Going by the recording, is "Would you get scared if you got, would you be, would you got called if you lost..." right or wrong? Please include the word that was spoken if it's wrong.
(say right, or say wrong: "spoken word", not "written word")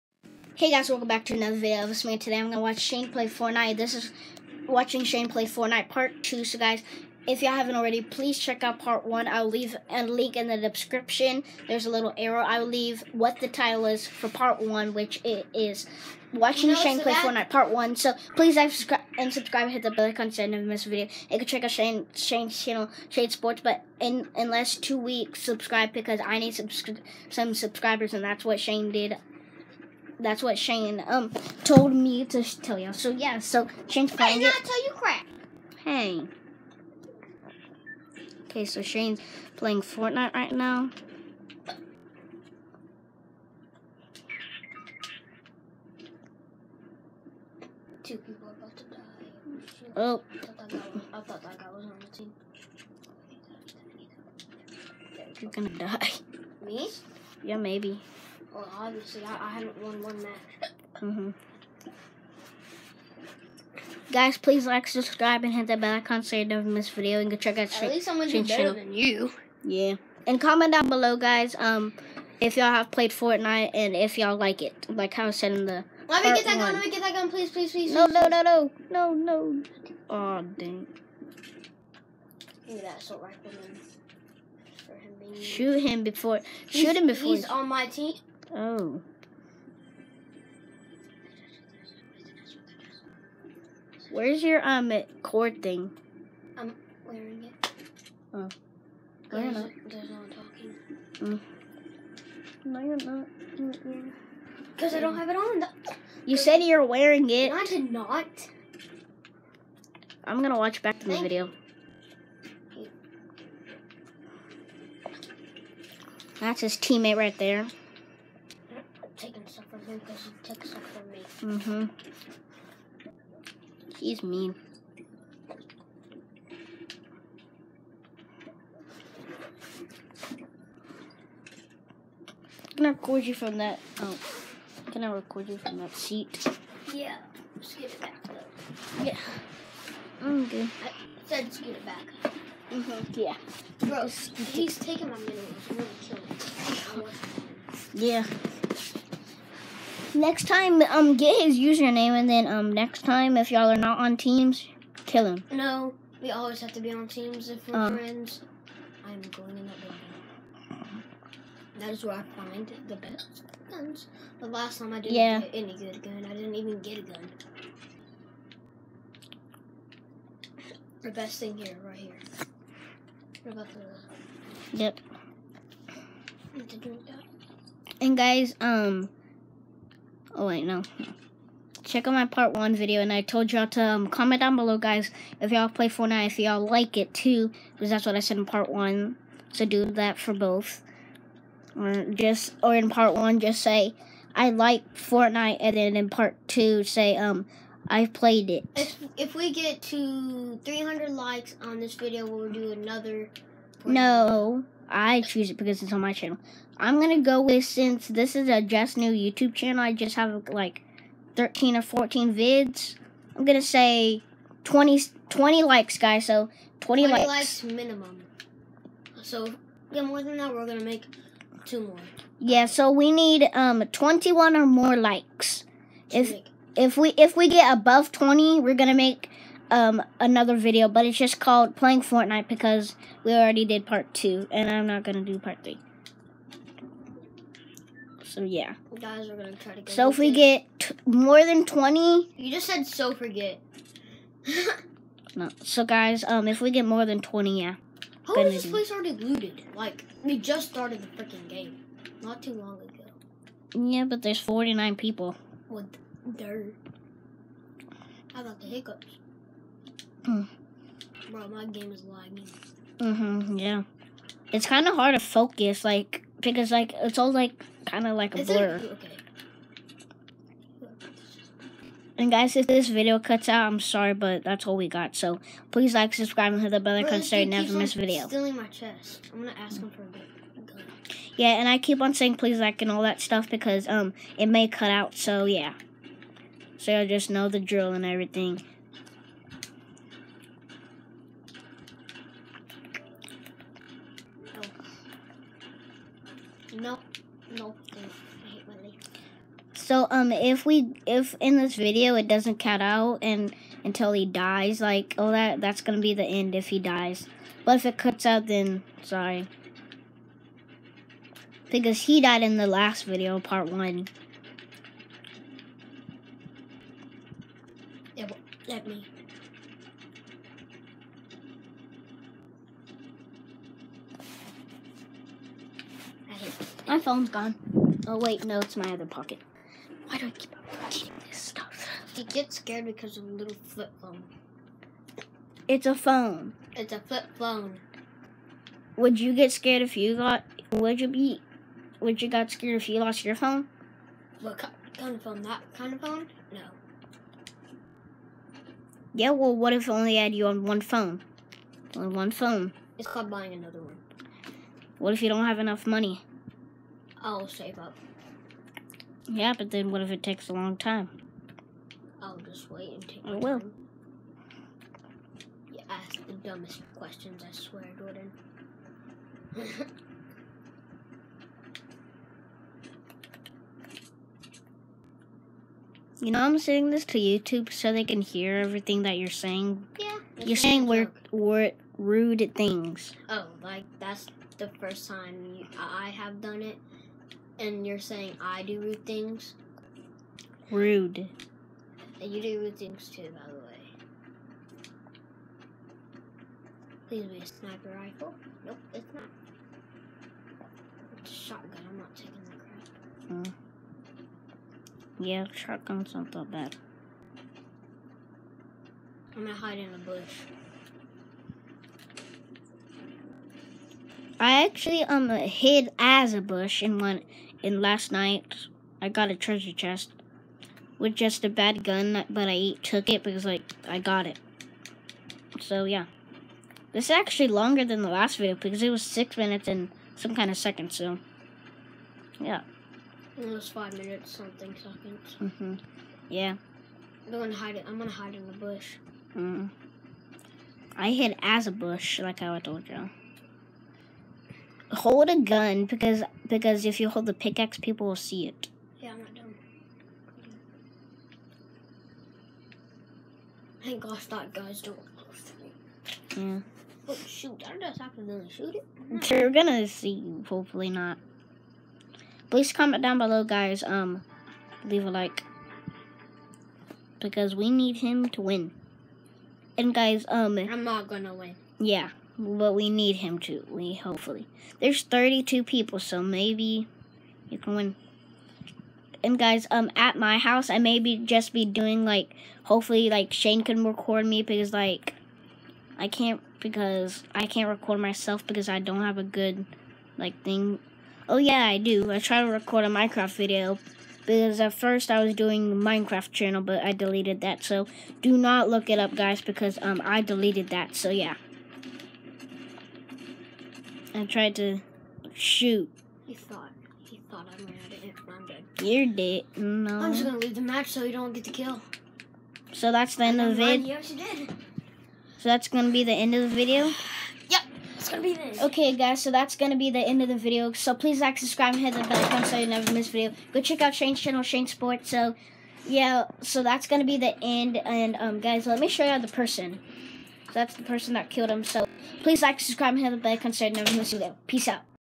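wrong: "scared", not "called".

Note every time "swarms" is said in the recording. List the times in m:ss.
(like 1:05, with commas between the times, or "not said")
not said.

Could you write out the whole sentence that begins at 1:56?
That's his teammate right there him because he took some from me.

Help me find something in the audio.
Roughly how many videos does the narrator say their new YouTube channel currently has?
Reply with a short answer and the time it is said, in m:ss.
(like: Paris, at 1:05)
13 or 14, at 3:31.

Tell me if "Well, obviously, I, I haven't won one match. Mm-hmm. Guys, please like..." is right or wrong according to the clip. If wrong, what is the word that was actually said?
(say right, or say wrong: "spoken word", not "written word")
right.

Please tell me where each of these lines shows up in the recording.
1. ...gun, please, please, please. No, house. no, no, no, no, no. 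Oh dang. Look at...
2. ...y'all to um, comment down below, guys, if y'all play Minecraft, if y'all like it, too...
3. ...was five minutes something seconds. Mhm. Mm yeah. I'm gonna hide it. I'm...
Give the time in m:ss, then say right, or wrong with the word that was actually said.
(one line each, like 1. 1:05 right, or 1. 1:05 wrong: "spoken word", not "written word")
1. 1:17 wrong: "please", not "house"
2. 3:03 wrong: "Fortnite", not "Minecraft"
3. 7:13 right.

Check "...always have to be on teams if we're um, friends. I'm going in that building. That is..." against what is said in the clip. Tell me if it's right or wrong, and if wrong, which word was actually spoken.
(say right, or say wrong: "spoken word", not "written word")
right.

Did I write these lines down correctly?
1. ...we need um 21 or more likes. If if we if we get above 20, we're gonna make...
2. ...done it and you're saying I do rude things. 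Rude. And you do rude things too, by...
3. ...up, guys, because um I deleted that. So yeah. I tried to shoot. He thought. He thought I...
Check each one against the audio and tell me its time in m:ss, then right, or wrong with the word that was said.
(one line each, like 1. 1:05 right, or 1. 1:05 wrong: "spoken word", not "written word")
1. 3:42 right
2. 6:26 right
3. 8:18 right.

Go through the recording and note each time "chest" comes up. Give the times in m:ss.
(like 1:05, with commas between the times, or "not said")
4:38, 6:59.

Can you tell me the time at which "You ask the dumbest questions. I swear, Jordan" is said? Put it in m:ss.
6:05.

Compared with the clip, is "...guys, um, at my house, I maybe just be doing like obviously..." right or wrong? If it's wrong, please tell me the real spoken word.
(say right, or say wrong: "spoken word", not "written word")
wrong: "hopefully", not "obviously".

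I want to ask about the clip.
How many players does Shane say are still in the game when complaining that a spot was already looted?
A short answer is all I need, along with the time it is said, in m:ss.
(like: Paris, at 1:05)
49, at 4:14.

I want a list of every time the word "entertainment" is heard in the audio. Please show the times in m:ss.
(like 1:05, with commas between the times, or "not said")
not said.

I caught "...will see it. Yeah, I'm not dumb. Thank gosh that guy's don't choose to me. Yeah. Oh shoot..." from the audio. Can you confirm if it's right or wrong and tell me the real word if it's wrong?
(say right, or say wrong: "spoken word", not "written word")
wrong: "close", not "choose".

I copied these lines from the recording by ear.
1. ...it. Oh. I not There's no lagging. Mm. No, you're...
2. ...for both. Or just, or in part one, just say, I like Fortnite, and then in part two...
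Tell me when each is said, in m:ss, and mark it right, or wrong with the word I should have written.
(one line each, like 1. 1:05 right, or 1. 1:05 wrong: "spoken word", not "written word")
1. 1:37 wrong: "talking", not "lagging"
2. 3:10 right.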